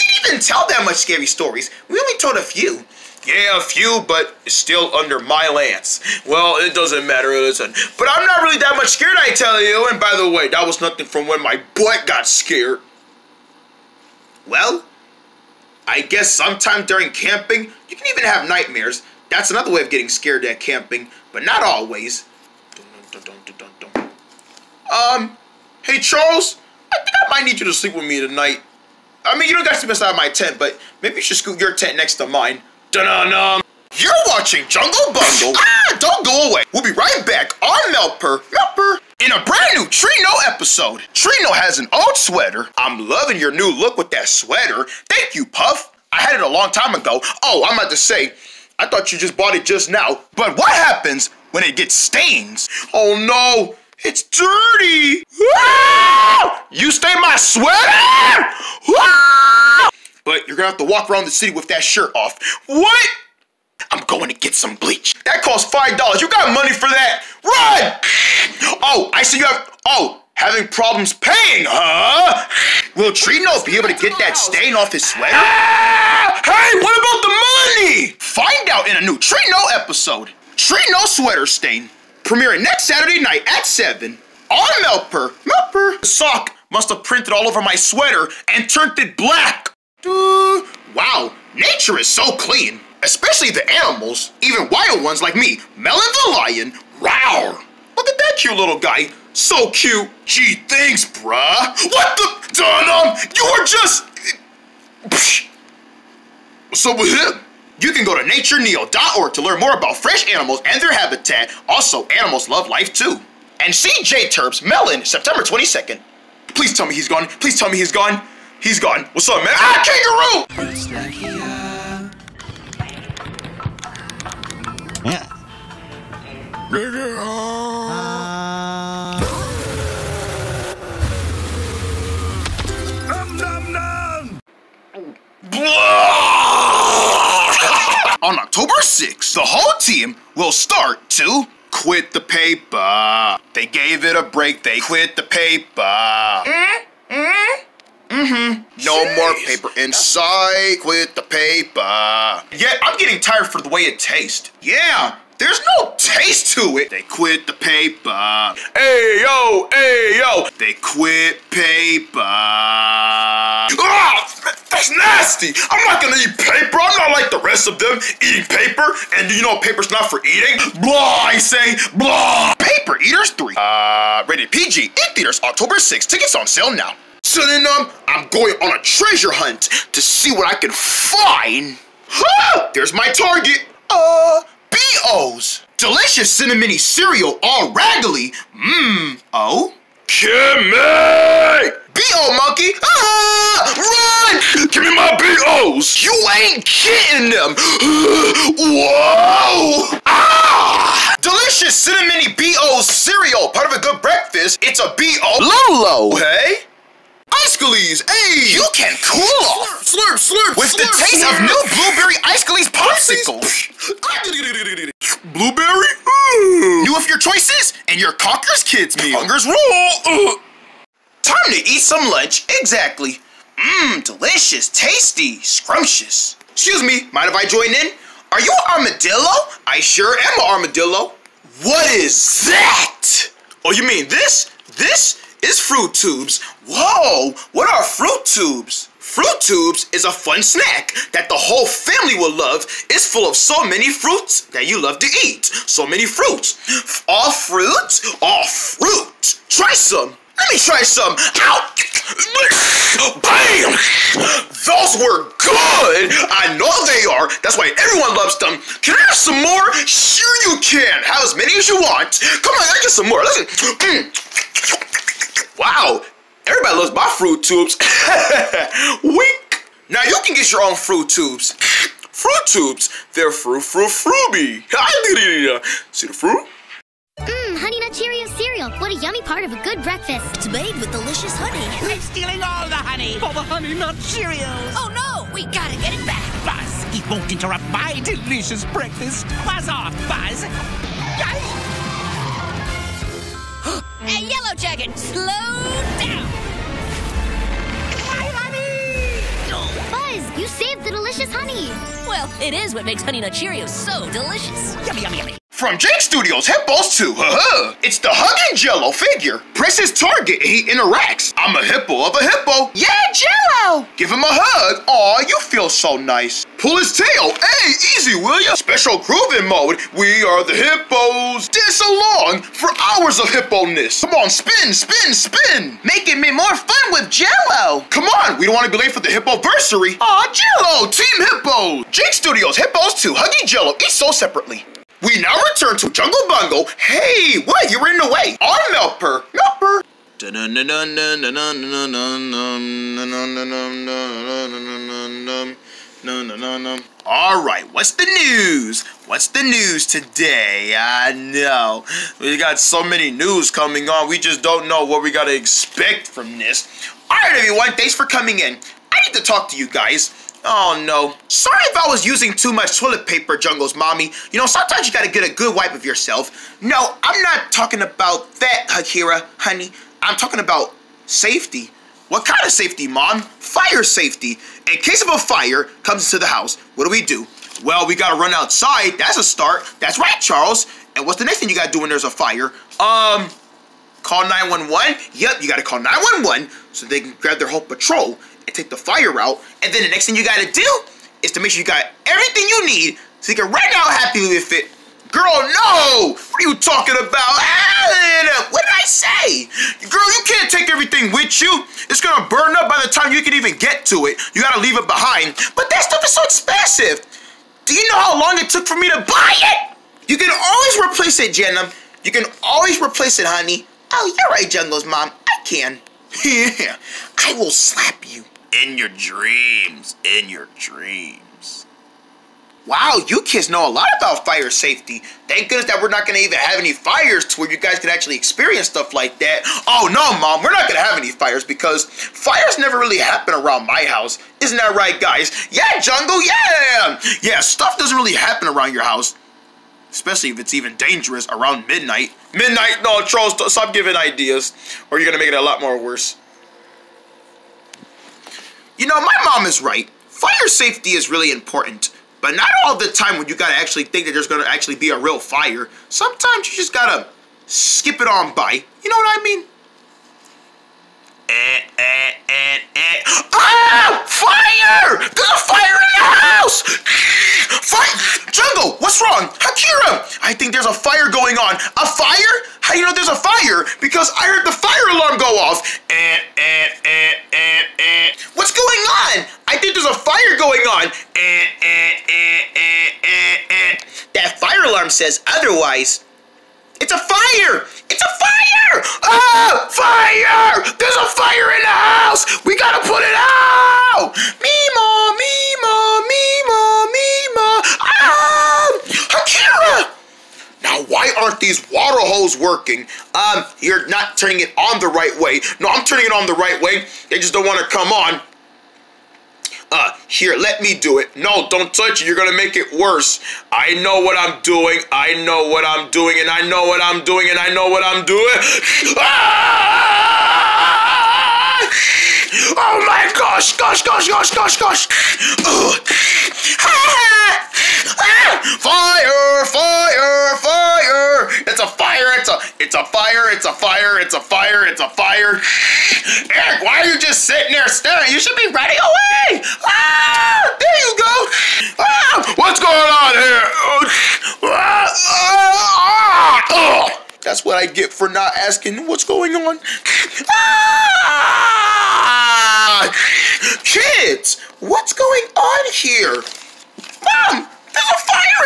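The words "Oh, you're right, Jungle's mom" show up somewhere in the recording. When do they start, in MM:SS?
06:53.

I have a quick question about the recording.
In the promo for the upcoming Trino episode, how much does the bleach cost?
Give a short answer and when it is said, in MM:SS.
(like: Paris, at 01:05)
$5, at 01:05.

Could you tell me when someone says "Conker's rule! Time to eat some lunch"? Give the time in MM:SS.
03:39.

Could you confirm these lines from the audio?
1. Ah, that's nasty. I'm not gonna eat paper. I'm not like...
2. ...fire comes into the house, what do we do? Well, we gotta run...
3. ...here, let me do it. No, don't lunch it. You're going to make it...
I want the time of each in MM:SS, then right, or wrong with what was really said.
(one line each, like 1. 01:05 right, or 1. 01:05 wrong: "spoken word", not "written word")
1. 02:43 right
2. 06:15 right
3. 08:30 wrong: "touch", not "lunch".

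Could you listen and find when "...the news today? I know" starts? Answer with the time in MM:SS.
05:49.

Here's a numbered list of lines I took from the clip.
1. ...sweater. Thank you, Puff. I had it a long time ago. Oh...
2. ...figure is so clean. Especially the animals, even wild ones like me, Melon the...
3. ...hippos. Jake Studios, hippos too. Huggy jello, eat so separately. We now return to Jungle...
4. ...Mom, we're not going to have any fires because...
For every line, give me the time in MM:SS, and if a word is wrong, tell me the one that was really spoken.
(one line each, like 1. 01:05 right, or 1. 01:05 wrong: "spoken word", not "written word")
1. 00:44 right
2. 01:31 wrong: "nature", not "figure"
3. 05:31 right
4. 07:10 right.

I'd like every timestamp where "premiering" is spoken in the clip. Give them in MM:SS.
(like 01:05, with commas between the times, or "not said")
01:22.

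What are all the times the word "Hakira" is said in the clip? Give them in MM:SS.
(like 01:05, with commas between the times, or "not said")
06:08, 07:49.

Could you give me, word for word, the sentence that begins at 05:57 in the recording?
All right, everyone, thanks for coming in.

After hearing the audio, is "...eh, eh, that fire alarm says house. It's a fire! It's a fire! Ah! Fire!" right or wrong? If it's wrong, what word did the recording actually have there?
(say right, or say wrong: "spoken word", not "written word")
wrong: "otherwise", not "house".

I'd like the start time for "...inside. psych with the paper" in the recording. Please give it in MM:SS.
02:29.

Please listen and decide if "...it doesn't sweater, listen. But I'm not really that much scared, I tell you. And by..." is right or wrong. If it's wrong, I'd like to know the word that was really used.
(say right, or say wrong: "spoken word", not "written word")
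wrong: "matter", not "sweater".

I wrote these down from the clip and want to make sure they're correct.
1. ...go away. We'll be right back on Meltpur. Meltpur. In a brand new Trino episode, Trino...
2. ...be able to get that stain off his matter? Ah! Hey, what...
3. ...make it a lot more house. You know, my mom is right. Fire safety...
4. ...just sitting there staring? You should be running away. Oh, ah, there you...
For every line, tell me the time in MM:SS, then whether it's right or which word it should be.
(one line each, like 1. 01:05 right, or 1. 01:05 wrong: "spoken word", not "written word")
1. 00:36 right
2. 01:13 wrong: "sweater", not "matter"
3. 07:25 wrong: "worse", not "house"
4. 08:56 right.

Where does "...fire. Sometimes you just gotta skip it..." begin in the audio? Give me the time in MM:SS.
07:35.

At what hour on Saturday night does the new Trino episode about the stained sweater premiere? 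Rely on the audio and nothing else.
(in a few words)
7.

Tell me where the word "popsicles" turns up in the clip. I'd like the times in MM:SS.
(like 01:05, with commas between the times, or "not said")
03:32.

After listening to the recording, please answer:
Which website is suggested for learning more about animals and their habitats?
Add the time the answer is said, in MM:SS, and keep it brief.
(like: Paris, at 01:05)
natureneo.org, at 01:48.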